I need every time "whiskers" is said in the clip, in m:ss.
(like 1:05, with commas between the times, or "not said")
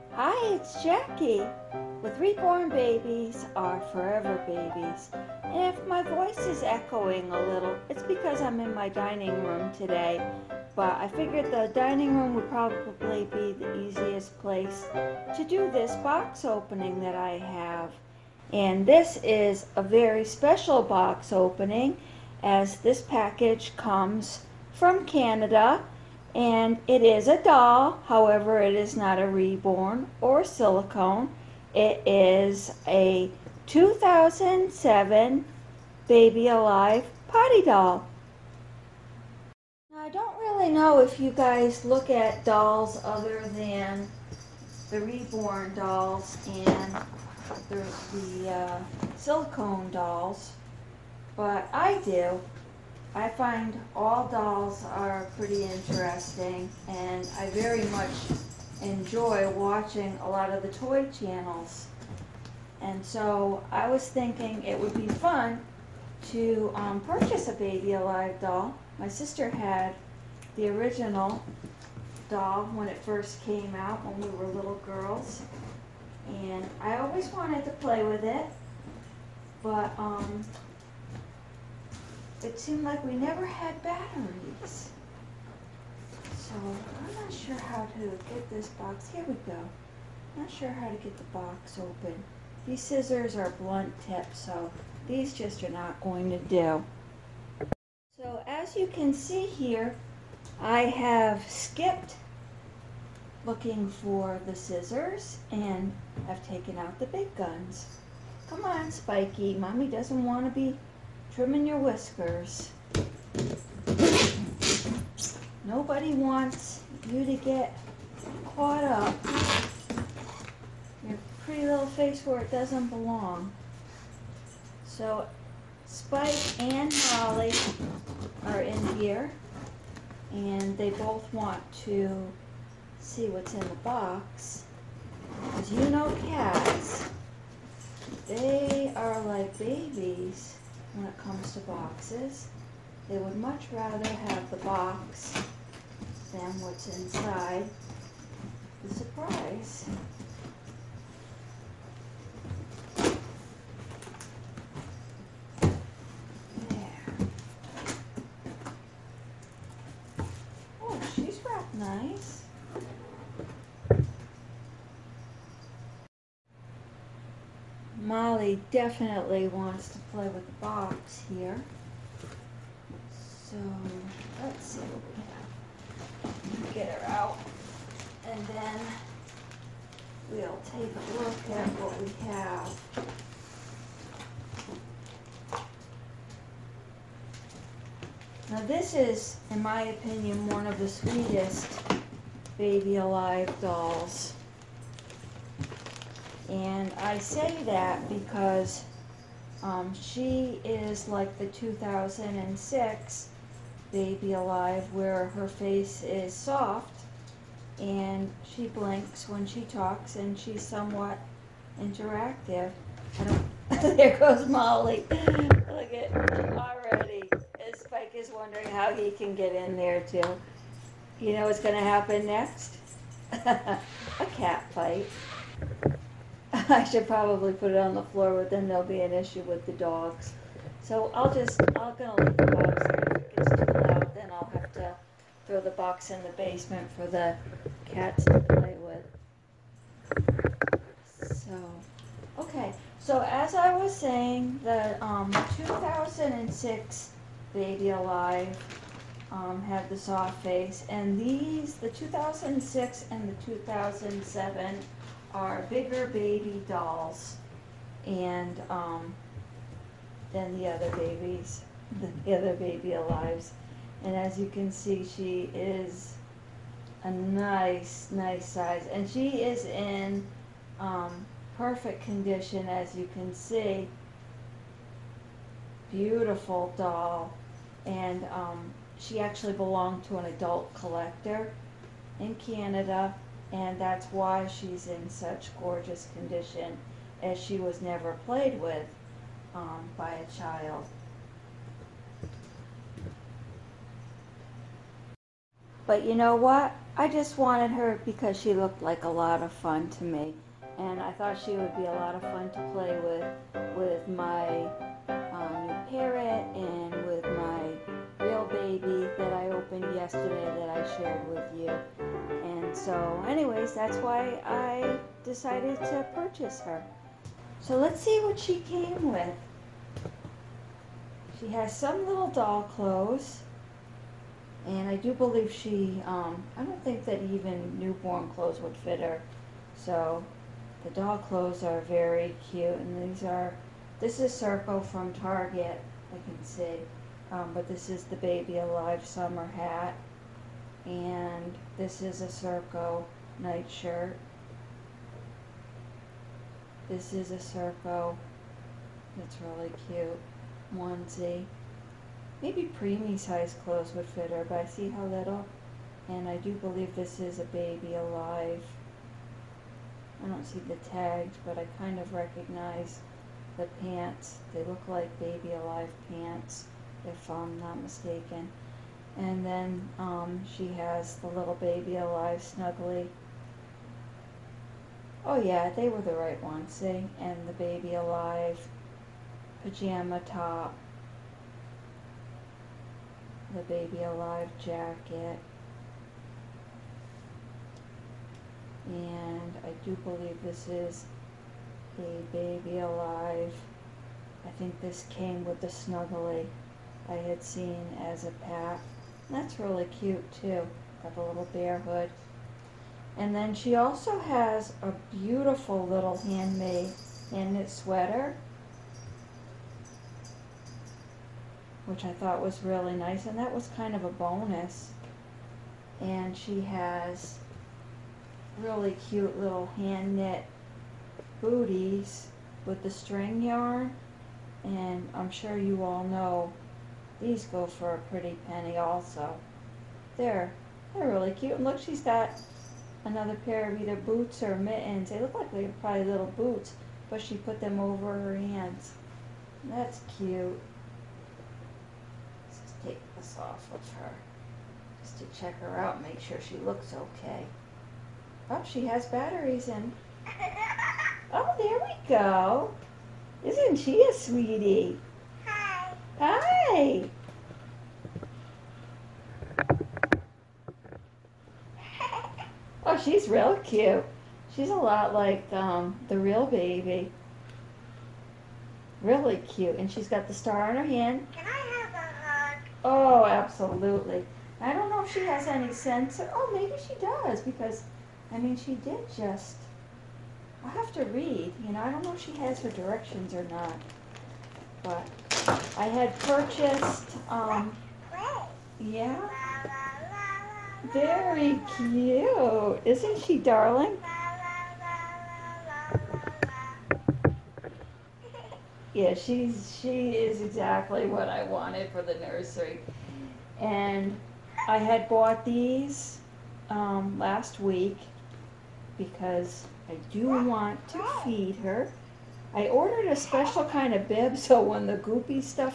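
1:51.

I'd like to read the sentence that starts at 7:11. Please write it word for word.
And look, she's got another pair of either boots or mittens.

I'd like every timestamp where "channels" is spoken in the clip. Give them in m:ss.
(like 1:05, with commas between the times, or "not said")
1:01.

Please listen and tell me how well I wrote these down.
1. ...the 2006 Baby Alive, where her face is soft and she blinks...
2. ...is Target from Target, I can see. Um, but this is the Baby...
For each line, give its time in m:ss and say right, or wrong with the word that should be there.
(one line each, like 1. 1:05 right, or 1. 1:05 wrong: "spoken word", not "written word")
1. 3:21 right
2. 5:34 wrong: "Circo", not "Target".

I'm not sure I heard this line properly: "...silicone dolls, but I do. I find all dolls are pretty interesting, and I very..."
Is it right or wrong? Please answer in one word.
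right.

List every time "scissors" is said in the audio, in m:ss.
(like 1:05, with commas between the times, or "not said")
1:32, 1:44.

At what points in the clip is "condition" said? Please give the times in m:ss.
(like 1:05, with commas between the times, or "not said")
4:32, 4:46.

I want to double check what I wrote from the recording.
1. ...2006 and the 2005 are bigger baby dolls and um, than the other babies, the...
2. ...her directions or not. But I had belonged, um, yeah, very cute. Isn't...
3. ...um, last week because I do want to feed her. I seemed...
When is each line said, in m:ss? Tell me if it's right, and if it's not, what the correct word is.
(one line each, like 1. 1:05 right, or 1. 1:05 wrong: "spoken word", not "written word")
1. 4:11 wrong: "2007", not "2005"
2. 8:02 wrong: "purchased", not "belonged"
3. 8:26 wrong: "ordered", not "seemed".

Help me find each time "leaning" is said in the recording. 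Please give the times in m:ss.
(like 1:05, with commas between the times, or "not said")
not said.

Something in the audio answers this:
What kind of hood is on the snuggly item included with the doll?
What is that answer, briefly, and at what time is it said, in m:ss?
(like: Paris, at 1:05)
bear hood, at 6:41.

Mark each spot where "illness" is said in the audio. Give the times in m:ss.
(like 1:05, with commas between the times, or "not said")
not said.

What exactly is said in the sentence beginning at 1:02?
And so I was thinking it would be fun to um, purchase a Baby Alive doll.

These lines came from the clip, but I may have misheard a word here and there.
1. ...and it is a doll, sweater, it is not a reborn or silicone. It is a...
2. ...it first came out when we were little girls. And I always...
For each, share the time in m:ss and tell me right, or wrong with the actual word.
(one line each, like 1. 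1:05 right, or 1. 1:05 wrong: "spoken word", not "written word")
1. 0:26 wrong: "however", not "sweater"
2. 1:12 right.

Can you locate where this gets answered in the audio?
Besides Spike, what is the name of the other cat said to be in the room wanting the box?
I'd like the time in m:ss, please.
2:06.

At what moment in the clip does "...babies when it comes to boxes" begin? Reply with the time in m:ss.
2:19.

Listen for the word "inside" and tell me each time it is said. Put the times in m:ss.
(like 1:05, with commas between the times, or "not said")
2:26.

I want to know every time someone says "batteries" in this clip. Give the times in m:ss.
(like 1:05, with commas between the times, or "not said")
1:23, 7:29.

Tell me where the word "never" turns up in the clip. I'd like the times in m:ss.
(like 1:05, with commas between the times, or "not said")
1:23, 4:47.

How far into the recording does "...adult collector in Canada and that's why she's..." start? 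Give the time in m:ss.
4:40.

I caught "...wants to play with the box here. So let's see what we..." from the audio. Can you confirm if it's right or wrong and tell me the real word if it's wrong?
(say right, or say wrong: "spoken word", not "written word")
right.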